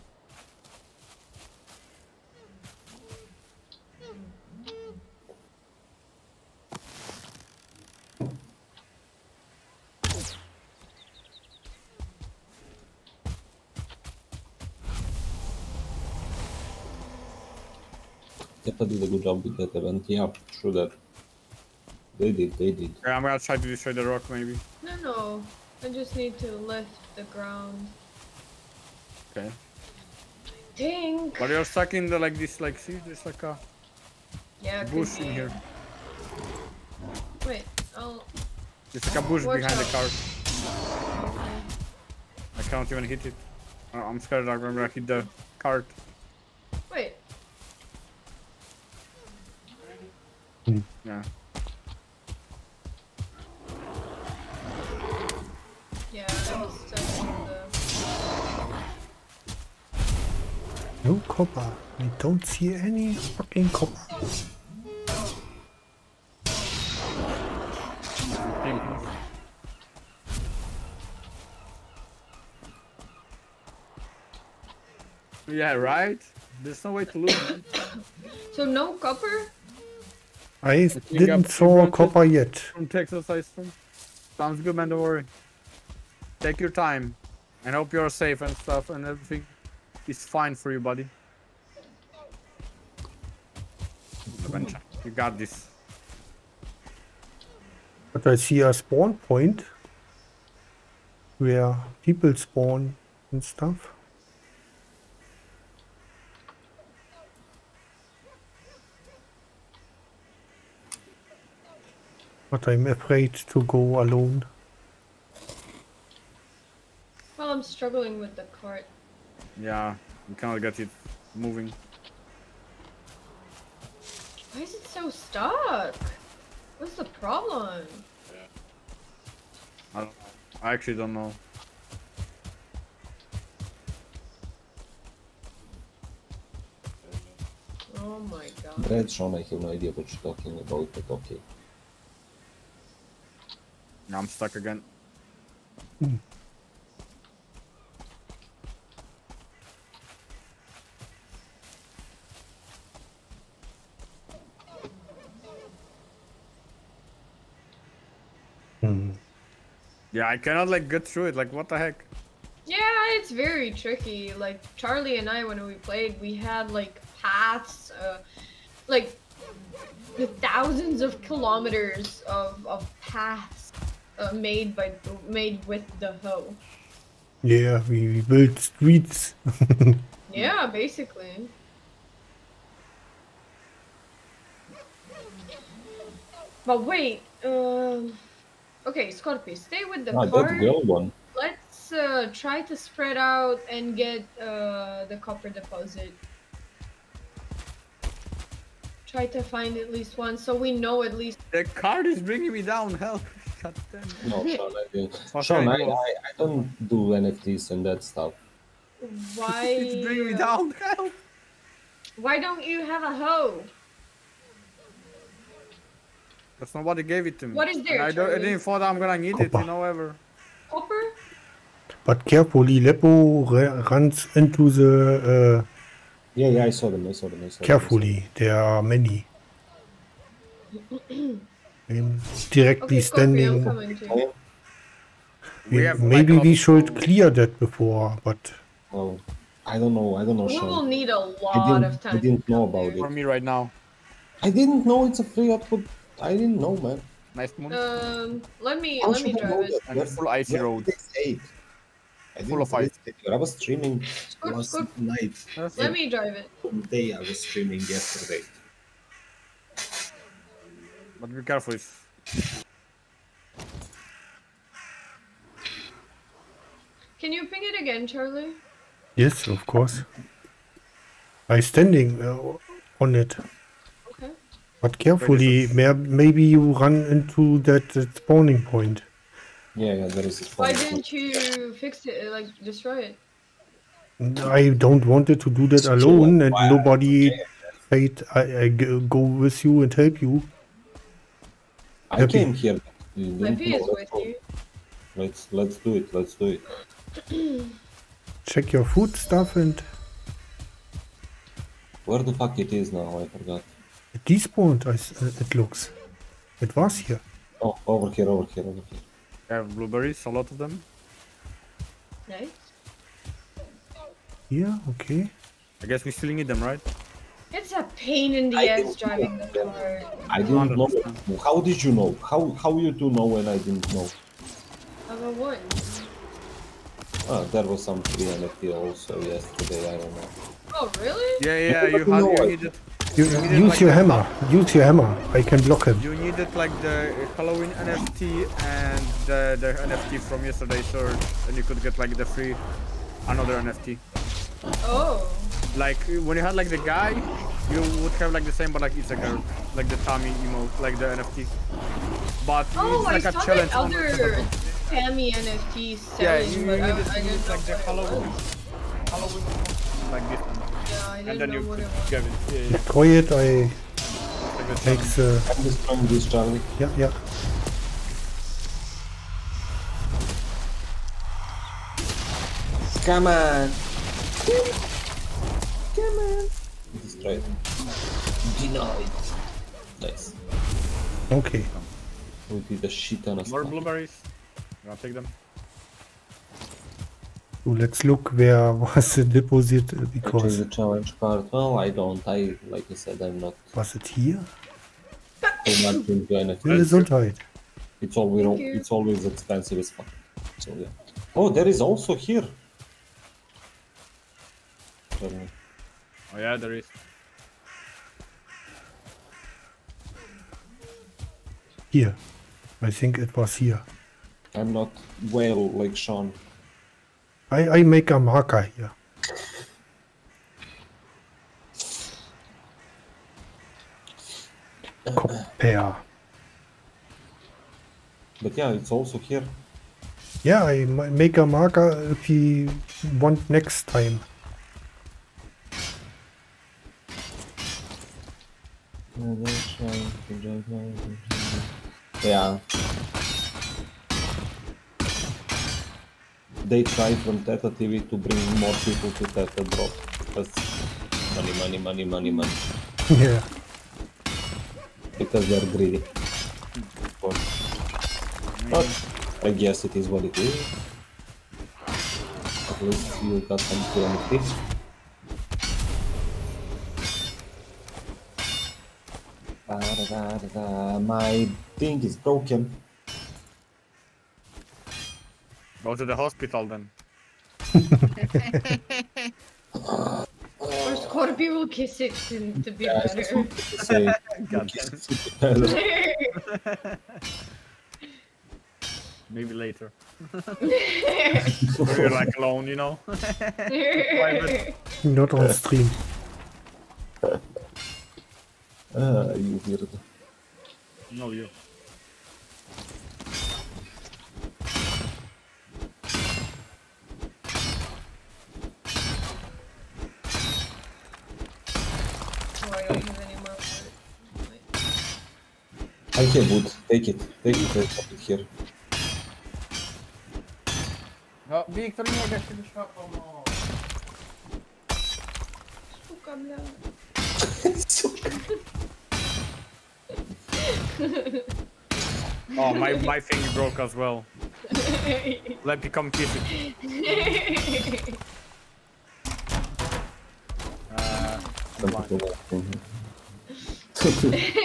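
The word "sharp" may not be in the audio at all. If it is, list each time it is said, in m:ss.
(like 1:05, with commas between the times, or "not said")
not said.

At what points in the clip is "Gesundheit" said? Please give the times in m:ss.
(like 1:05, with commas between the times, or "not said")
6:36.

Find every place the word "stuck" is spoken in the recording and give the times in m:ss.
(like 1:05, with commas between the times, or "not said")
0:31, 2:05, 2:24.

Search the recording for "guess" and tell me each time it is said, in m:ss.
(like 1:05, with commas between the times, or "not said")
5:15, 7:39.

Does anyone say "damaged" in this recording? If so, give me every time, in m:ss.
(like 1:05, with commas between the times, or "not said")
not said.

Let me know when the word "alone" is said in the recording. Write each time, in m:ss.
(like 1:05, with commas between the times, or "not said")
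1:54, 4:45, 8:12.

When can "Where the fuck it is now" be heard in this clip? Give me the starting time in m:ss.
5:02.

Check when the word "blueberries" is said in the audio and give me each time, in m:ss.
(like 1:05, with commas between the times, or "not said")
5:09, 6:23.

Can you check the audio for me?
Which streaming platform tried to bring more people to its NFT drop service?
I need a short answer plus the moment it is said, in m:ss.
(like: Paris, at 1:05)
Theta TV, at 7:27.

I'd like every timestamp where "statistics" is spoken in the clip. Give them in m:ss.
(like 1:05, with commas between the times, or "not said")
not said.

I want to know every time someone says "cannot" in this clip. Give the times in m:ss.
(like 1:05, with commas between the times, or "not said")
2:00, 2:40.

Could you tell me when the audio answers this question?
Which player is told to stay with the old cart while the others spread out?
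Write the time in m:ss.
3:09.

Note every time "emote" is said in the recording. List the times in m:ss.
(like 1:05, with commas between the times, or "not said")
5:50.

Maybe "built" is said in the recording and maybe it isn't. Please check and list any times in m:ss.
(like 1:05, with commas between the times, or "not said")
2:58.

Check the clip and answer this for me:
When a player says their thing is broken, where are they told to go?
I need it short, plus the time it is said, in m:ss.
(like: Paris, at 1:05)
Hospital, at 7:55.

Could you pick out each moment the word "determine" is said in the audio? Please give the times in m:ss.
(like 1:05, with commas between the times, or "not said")
not said.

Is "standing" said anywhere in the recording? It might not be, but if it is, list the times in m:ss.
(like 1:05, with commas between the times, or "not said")
3:53, 4:31.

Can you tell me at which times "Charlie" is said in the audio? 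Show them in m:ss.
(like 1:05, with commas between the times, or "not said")
2:44, 4:28, 6:06.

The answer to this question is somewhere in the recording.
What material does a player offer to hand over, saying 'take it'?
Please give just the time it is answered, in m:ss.
8:36.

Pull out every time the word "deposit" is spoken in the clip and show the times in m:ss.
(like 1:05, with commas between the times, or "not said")
3:15, 6:29.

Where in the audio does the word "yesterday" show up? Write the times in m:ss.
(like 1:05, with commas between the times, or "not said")
4:17, 5:29, 5:40.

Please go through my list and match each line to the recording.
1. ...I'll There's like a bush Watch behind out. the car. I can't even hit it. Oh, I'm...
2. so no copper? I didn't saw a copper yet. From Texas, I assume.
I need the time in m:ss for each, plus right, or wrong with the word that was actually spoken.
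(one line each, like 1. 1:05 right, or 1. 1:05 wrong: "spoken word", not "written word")
1. 0:37 right
2. 1:18 right.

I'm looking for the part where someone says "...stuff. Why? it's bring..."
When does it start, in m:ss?
3:28.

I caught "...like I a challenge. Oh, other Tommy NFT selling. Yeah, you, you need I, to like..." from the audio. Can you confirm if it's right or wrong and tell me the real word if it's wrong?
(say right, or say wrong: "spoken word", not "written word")
wrong: "Tammy", not "Tommy".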